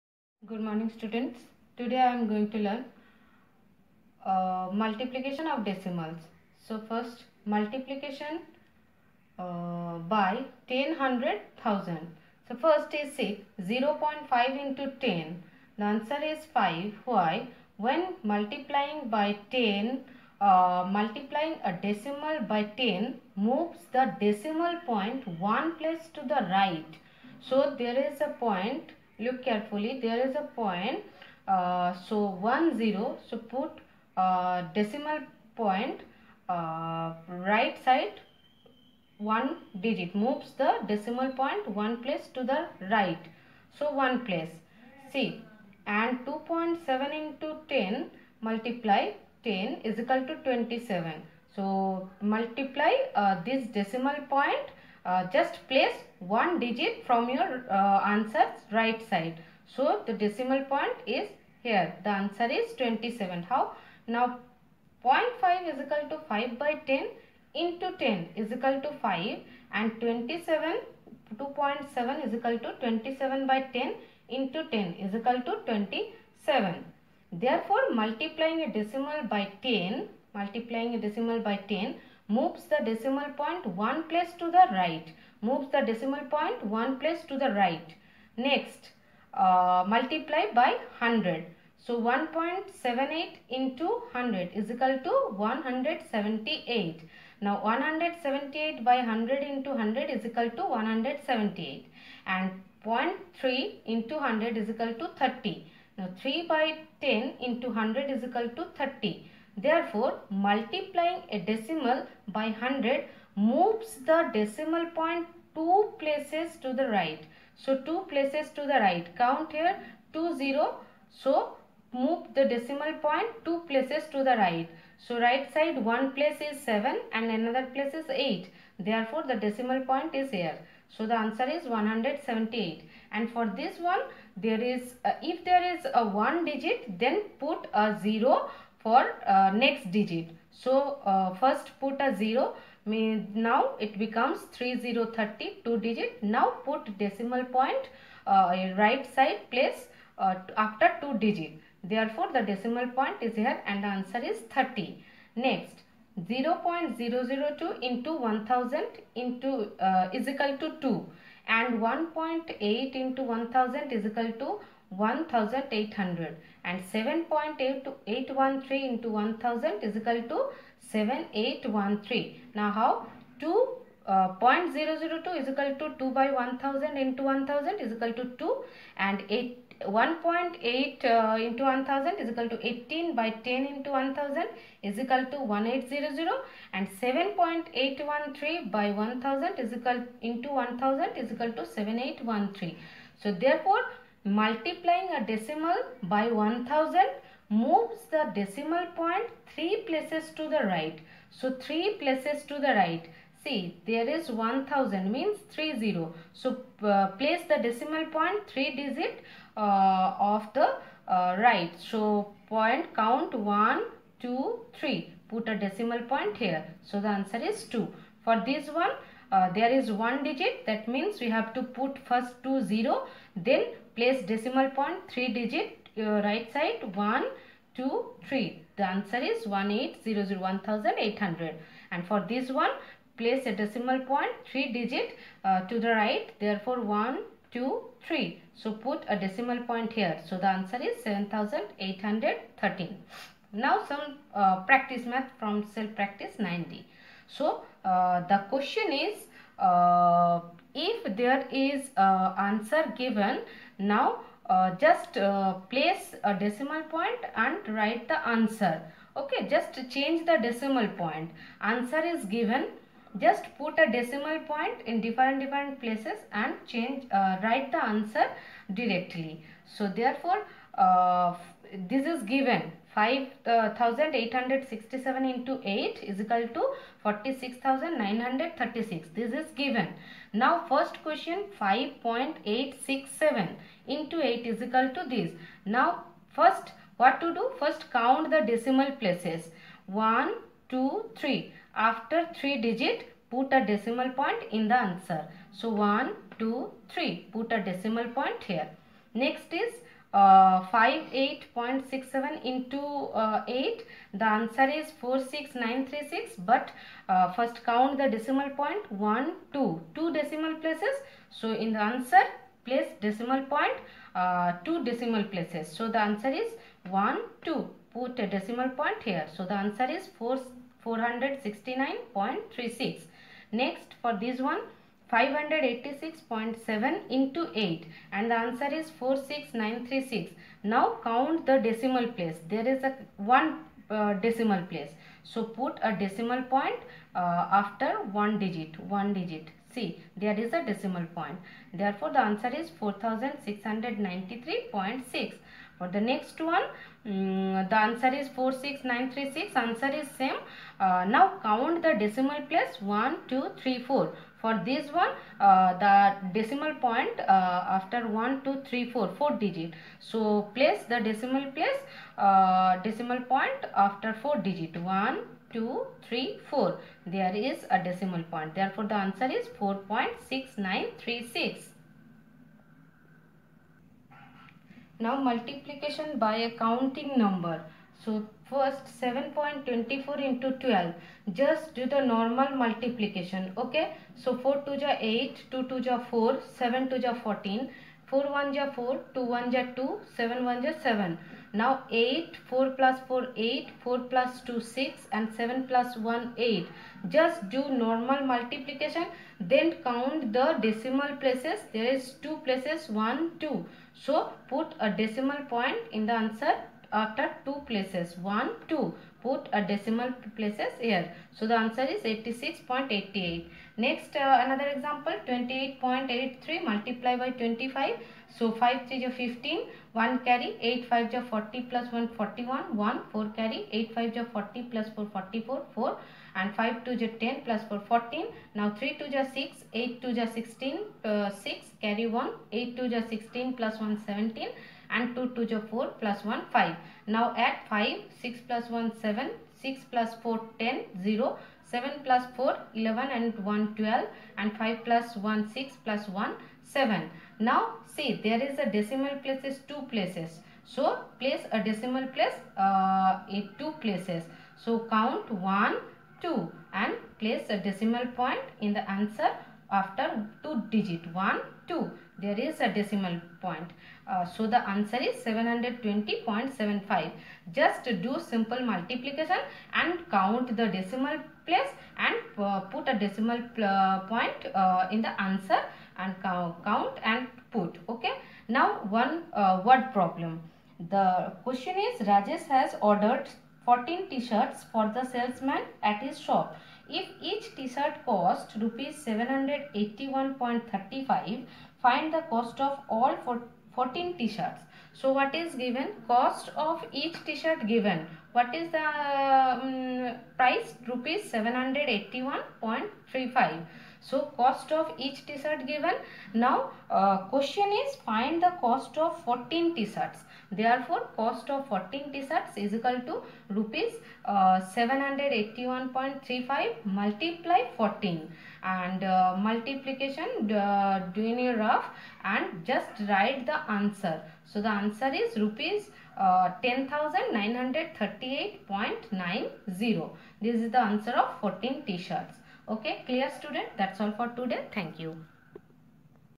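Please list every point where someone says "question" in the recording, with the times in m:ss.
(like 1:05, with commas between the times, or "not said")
4:08, 4:41, 8:01, 8:27.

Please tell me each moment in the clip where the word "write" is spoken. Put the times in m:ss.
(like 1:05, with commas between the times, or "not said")
4:17, 4:27, 8:43.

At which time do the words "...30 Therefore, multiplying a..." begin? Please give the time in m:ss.
1:48.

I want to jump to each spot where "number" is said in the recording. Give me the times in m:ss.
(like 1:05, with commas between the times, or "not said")
6:17.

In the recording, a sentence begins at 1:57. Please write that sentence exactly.
So, 2 places to the right.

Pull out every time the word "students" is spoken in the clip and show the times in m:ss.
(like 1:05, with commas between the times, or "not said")
0:00, 8:53.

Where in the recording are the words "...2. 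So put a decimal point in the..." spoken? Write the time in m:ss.
6:43.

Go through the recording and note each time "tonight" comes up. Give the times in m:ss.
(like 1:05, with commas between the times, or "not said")
not said.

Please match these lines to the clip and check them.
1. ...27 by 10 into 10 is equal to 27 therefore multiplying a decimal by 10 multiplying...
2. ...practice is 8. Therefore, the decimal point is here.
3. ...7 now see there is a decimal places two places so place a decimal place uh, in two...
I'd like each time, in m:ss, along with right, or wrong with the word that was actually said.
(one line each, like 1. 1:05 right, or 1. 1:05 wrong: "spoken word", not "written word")
1. 1:12 right
2. 2:07 wrong: "place", not "practice"
3. 7:26 right.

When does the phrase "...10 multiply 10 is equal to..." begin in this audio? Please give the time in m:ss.
0:47.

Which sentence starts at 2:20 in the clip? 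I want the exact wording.
So uh, first put a 0 Means now it becomes 3030 two digit.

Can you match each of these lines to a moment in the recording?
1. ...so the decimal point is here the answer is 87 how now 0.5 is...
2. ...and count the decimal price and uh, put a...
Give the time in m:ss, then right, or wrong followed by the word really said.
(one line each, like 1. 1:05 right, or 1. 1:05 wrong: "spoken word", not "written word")
1. 0:59 wrong: "27", not "87"
2. 7:49 wrong: "place", not "price".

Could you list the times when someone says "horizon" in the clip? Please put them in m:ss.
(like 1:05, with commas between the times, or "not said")
not said.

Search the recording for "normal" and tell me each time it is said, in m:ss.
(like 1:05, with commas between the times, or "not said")
6:22, 6:37.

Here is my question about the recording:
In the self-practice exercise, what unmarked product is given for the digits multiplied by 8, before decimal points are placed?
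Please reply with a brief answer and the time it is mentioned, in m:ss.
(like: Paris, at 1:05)
46936, at 4:36.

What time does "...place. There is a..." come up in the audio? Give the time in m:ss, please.
5:32.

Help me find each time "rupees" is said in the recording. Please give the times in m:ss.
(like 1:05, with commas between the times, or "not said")
8:08, 8:20, 8:33, 8:45.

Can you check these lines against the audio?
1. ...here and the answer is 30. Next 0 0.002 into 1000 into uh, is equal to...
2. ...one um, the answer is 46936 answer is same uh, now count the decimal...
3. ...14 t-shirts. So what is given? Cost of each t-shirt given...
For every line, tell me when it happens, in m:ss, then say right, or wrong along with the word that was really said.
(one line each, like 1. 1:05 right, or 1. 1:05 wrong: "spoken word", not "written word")
1. 2:33 right
2. 5:46 right
3. 8:13 right.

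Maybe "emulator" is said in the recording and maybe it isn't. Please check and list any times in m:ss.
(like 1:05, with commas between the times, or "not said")
not said.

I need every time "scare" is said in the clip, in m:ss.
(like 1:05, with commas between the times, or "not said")
not said.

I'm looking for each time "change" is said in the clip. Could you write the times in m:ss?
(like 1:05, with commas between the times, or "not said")
4:19, 4:26.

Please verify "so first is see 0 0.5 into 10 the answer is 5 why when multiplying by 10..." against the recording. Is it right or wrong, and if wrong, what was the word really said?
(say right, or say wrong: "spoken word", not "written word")
right.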